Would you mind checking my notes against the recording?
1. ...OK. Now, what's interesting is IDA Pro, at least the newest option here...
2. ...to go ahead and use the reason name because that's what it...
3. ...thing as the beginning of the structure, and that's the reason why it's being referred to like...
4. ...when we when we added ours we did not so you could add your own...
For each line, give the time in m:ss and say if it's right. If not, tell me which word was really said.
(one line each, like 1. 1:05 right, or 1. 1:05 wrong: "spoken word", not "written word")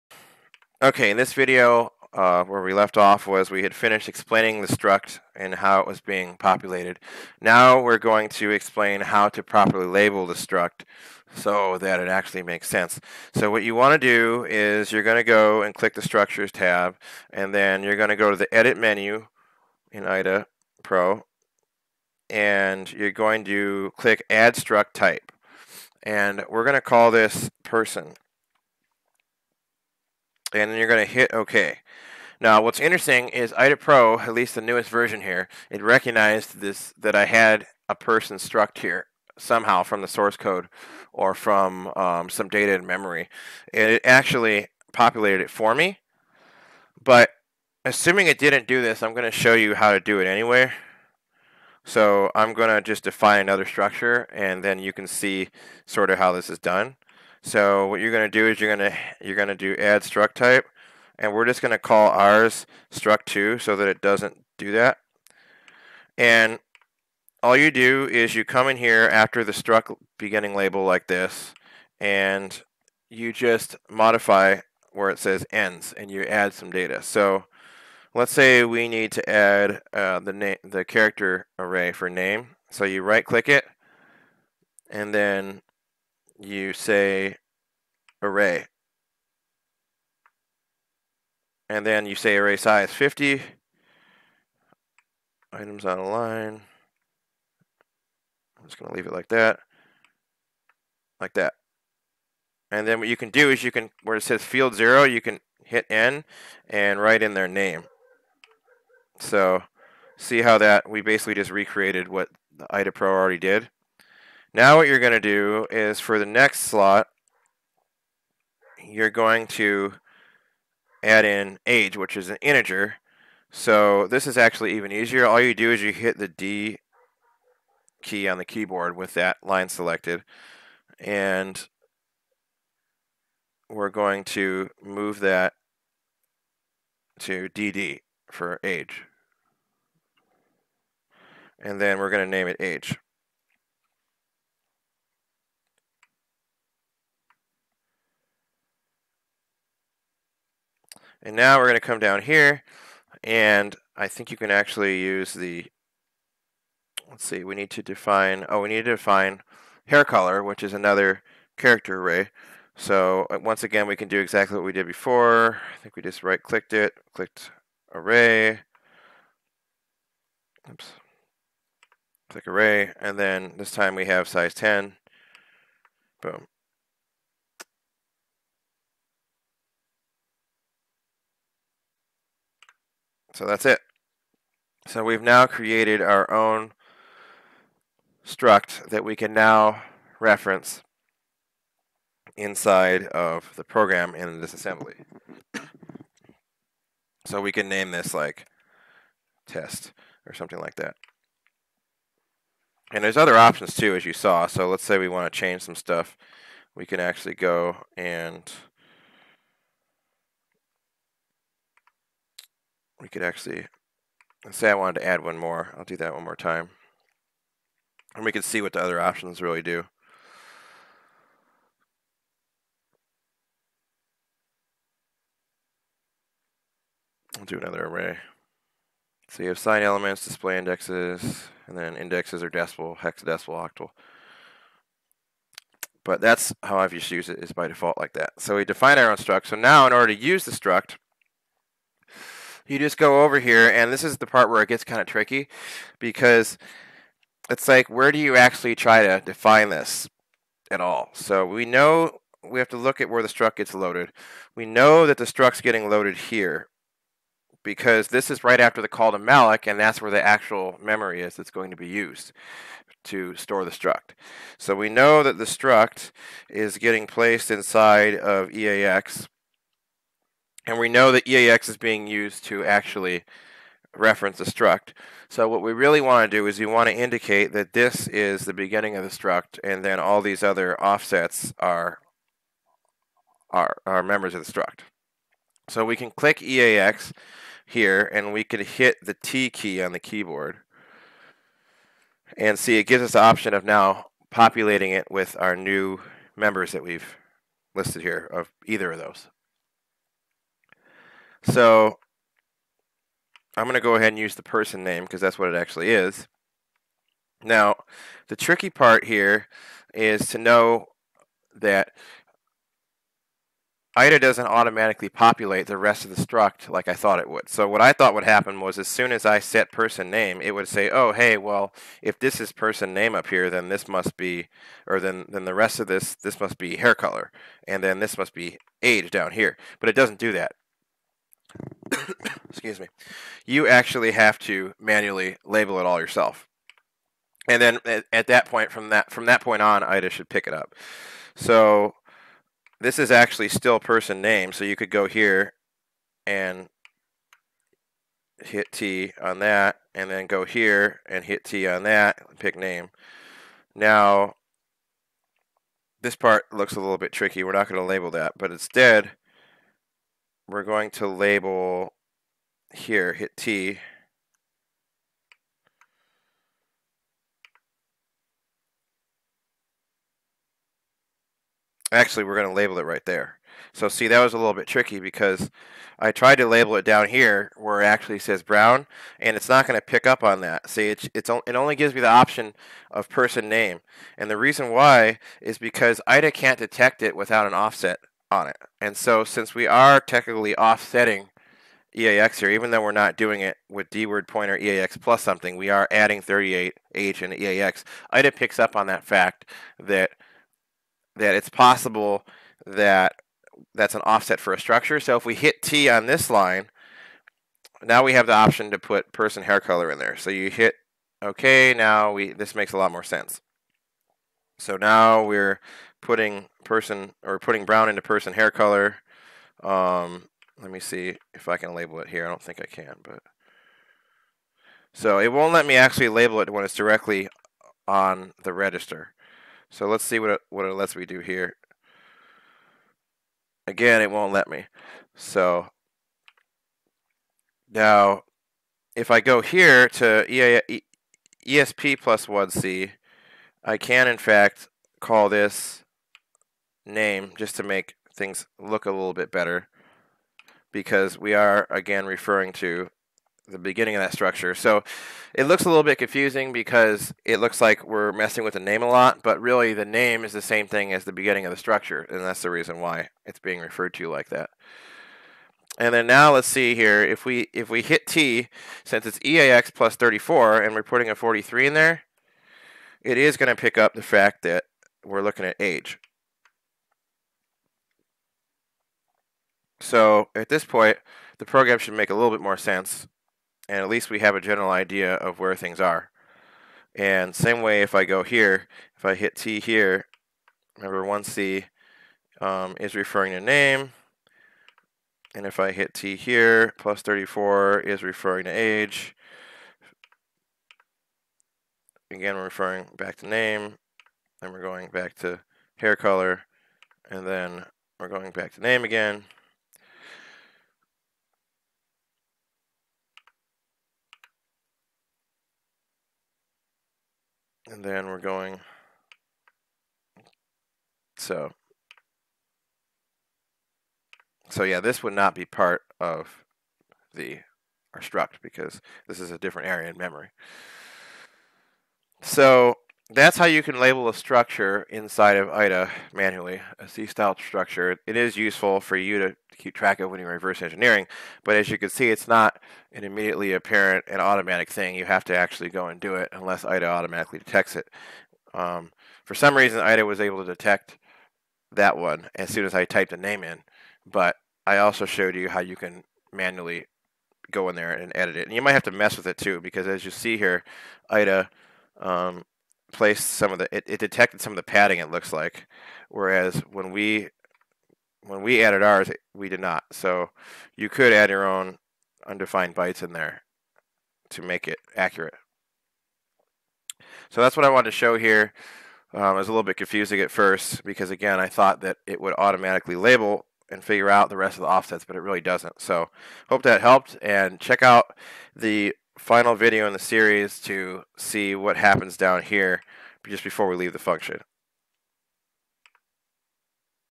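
1. 0:31 wrong: "version", not "option"
2. 5:03 wrong: "person", not "reason"
3. 7:40 right
4. 9:26 right.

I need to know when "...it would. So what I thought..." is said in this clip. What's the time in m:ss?
5:17.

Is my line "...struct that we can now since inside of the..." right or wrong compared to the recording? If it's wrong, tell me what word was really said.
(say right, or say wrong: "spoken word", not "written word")
wrong: "reference", not "since".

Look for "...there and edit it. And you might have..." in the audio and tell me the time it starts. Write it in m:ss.
9:17.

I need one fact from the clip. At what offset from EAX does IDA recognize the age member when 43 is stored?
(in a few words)
34.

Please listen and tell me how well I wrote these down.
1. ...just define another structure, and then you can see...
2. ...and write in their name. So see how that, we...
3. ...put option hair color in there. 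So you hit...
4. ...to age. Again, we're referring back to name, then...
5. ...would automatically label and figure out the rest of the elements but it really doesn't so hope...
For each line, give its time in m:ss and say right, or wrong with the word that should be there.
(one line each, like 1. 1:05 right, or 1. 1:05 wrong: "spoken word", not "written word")
1. 0:52 right
2. 1:46 right
3. 6:48 wrong: "person", not "option"
4. 8:18 right
5. 9:42 wrong: "offsets", not "elements".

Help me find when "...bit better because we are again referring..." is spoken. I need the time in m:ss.
7:29.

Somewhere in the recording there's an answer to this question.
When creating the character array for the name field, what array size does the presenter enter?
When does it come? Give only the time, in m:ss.
1:32.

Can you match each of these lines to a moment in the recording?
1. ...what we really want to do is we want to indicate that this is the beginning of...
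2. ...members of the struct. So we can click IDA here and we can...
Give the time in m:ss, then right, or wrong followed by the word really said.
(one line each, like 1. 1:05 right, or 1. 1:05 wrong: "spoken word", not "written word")
1. 4:35 right
2. 4:44 wrong: "EAX", not "IDA".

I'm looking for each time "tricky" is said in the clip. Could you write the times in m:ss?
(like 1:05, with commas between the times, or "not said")
4:05, 5:08, 5:57, 6:14.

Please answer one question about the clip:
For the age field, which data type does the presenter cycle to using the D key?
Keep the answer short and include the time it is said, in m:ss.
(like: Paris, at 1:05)
DD, at 2:17.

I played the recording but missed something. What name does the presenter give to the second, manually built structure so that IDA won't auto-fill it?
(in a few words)
struct2.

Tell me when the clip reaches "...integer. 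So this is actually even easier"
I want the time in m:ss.
2:02.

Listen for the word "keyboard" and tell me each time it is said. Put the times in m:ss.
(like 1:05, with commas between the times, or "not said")
2:08, 4:49.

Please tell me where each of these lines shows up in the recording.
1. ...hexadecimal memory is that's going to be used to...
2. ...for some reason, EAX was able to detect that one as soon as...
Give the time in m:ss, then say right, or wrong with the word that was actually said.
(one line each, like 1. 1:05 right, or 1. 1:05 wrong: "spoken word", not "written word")
1. 4:20 wrong: "actual", not "hexadecimal"
2. 9:09 wrong: "IDA", not "EAX".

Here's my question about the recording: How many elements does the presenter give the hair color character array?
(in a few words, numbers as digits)
10.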